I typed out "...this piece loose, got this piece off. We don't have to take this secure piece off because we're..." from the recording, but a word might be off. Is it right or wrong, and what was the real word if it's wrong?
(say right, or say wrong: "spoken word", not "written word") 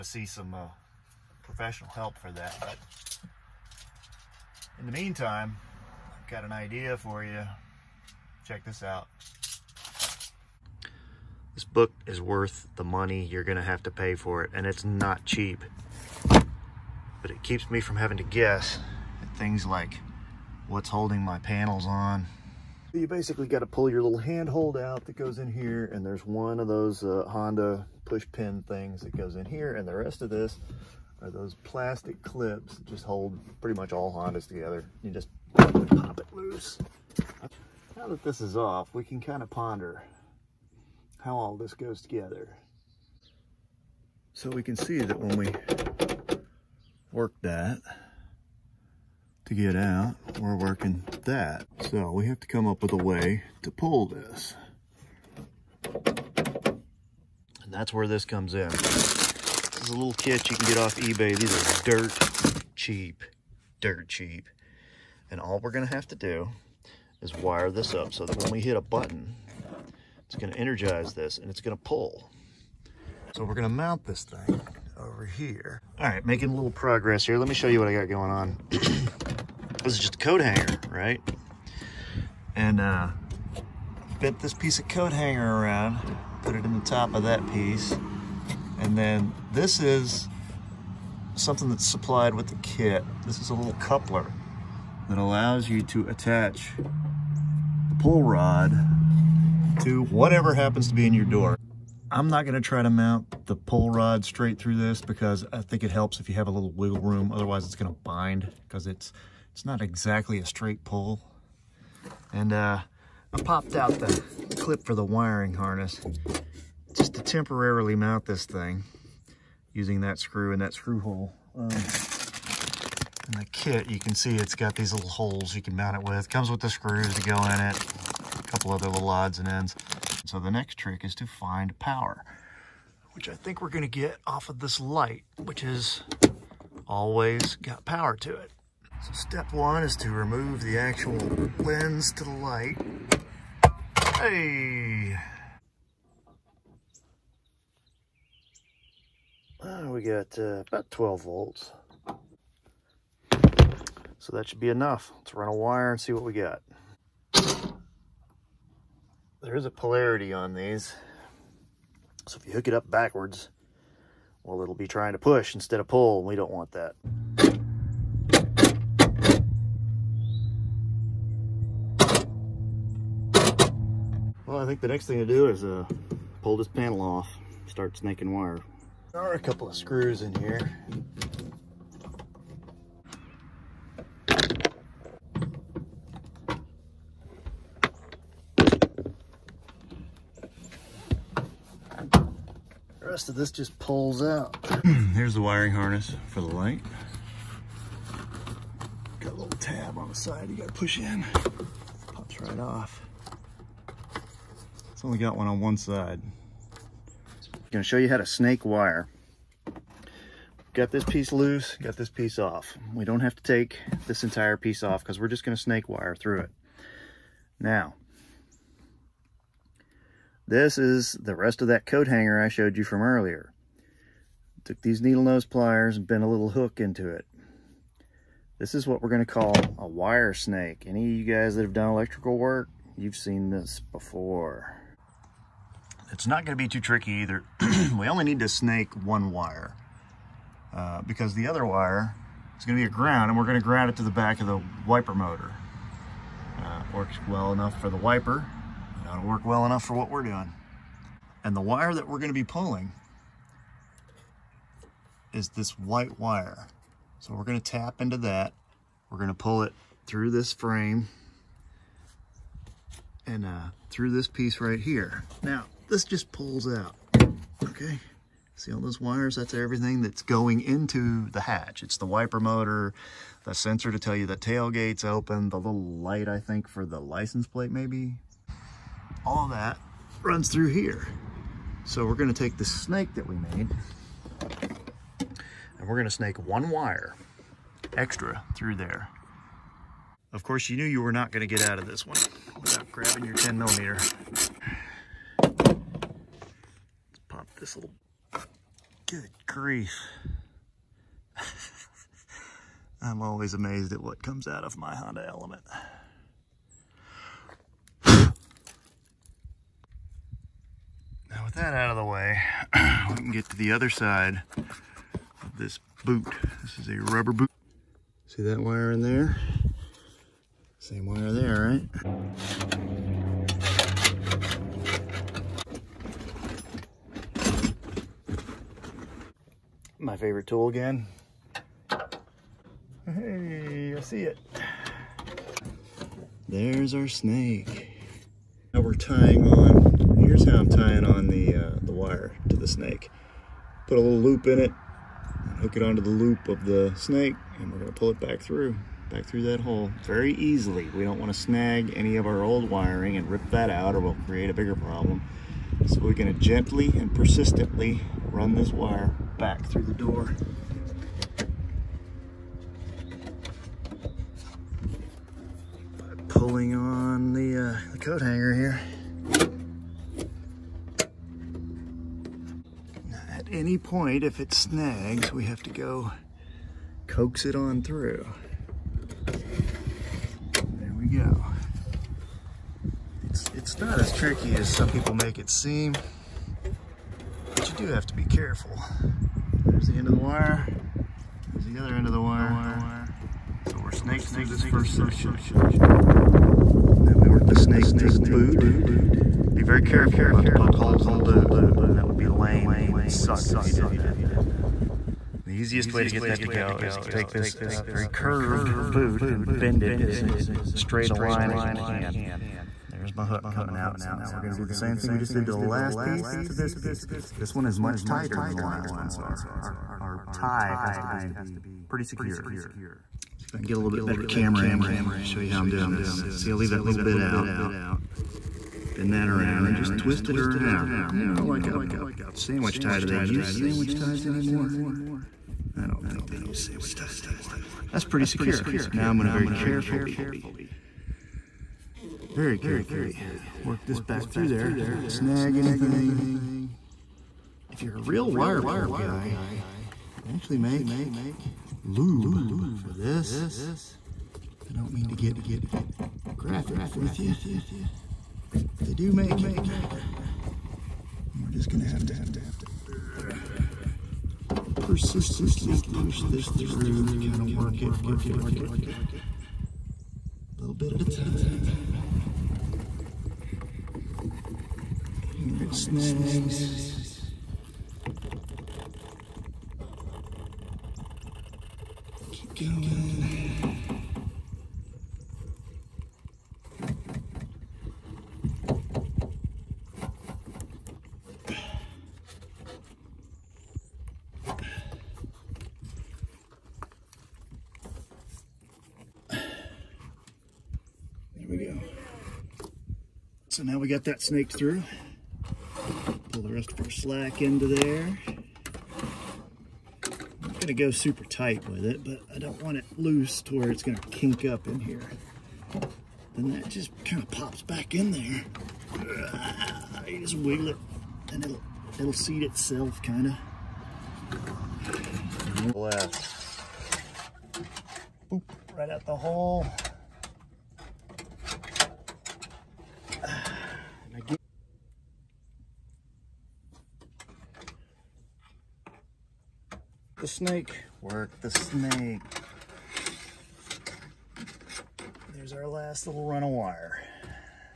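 wrong: "entire", not "secure".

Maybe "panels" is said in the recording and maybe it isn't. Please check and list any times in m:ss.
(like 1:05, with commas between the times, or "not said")
0:21, 2:56.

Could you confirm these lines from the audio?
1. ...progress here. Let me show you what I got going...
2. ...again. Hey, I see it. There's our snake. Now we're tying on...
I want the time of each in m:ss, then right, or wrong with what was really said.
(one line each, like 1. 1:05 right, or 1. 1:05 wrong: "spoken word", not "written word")
1. 1:16 right
2. 5:30 right.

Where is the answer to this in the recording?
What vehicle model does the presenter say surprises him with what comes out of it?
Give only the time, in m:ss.
5:04.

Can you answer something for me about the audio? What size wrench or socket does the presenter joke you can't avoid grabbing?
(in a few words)
10 millimeter.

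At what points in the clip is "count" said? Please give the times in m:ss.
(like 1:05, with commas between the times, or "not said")
not said.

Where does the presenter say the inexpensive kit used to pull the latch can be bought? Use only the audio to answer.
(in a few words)
eBay.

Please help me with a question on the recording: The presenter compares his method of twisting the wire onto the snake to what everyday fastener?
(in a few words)
sandwich tie.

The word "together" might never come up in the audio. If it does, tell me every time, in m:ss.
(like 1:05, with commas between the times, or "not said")
0:34, 0:42.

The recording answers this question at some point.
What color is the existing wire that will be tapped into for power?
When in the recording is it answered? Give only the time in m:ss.
4:15.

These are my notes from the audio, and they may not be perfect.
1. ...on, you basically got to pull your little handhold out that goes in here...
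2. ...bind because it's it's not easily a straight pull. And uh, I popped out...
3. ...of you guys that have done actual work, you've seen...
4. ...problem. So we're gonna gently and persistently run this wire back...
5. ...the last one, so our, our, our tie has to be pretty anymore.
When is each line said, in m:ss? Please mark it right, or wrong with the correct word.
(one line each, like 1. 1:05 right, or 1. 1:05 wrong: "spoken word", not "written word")
1. 0:21 right
2. 1:48 wrong: "exactly", not "easily"
3. 3:51 wrong: "electrical", not "actual"
4. 5:54 right
5. 6:58 wrong: "secure", not "anymore".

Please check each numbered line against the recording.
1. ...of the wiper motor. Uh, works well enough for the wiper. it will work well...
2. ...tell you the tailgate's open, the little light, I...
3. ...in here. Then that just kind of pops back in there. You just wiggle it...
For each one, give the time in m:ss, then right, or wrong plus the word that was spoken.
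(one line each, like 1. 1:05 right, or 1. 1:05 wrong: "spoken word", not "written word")
1. 4:04 right
2. 4:33 right
3. 8:34 right.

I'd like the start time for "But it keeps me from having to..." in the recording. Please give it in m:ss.
0:16.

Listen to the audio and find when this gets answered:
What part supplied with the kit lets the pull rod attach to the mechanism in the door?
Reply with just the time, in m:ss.
1:33.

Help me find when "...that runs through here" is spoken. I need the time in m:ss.
4:39.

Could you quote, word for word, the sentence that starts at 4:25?
Now, this just pulls out, okay?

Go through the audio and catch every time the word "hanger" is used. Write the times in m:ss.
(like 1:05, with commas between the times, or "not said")
1:20, 1:25, 3:42, 6:08.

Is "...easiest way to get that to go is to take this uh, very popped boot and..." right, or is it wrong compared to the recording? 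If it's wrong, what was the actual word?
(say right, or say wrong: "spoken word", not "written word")
wrong: "curved", not "popped".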